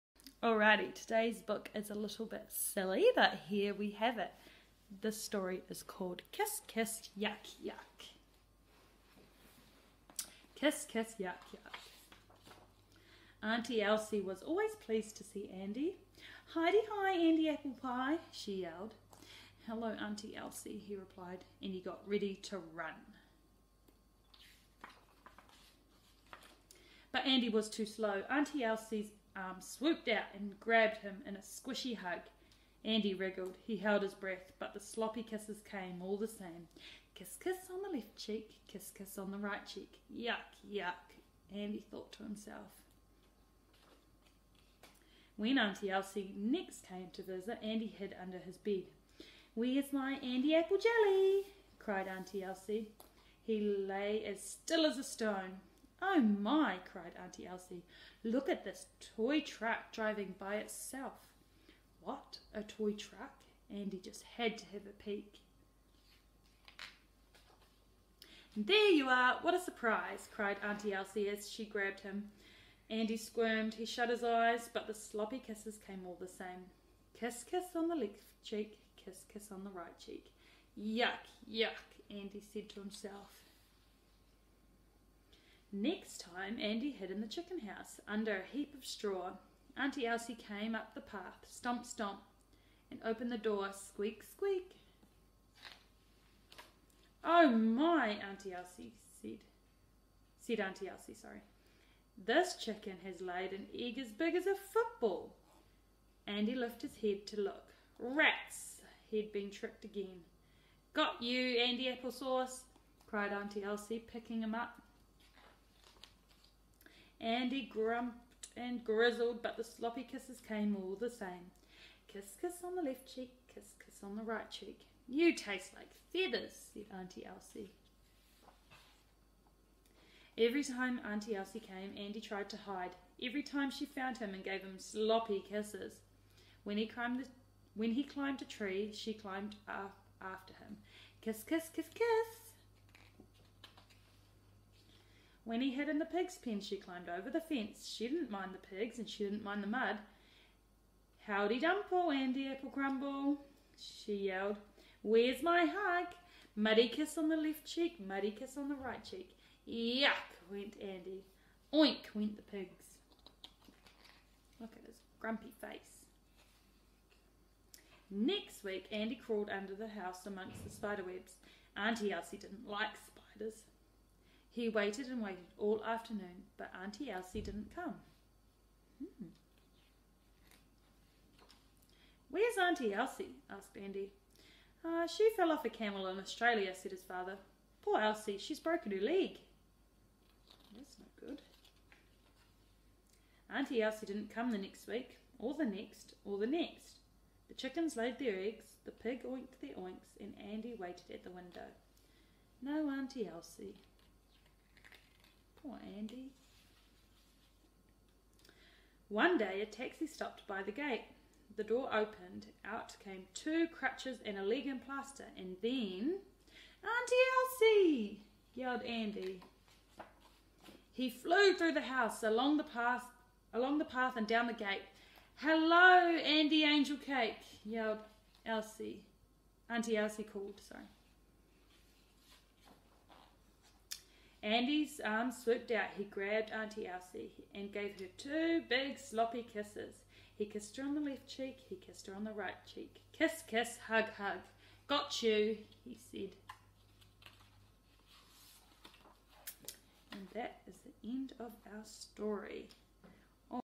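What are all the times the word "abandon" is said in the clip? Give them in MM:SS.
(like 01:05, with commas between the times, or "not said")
not said.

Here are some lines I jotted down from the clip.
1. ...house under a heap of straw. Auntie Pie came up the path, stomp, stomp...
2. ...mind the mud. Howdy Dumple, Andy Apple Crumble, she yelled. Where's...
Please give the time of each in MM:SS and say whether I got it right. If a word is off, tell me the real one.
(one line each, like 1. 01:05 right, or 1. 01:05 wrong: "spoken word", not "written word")
1. 01:27 wrong: "Elsie", not "Pie"
2. 02:29 right.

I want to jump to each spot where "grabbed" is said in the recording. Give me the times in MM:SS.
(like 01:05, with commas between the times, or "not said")
00:30, 01:11, 03:56.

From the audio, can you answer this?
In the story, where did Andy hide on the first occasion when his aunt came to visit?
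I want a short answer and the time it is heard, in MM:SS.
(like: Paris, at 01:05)
Under his bed, at 00:48.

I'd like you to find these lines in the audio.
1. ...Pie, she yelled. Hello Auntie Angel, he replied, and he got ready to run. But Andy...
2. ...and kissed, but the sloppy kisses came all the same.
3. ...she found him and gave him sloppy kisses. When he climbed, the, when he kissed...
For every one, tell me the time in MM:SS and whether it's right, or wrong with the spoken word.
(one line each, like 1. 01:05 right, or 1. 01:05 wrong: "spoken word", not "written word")
1. 00:17 wrong: "Elsie", not "Angel"
2. 01:58 wrong: "grizzled", not "kissed"
3. 02:13 wrong: "climbed", not "kissed".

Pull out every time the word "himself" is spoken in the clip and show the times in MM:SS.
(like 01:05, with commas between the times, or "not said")
00:42, 01:22.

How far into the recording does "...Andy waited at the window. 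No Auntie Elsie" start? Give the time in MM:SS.
03:20.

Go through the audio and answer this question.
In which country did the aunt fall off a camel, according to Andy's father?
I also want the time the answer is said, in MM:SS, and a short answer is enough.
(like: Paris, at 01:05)
Australia, at 03:06.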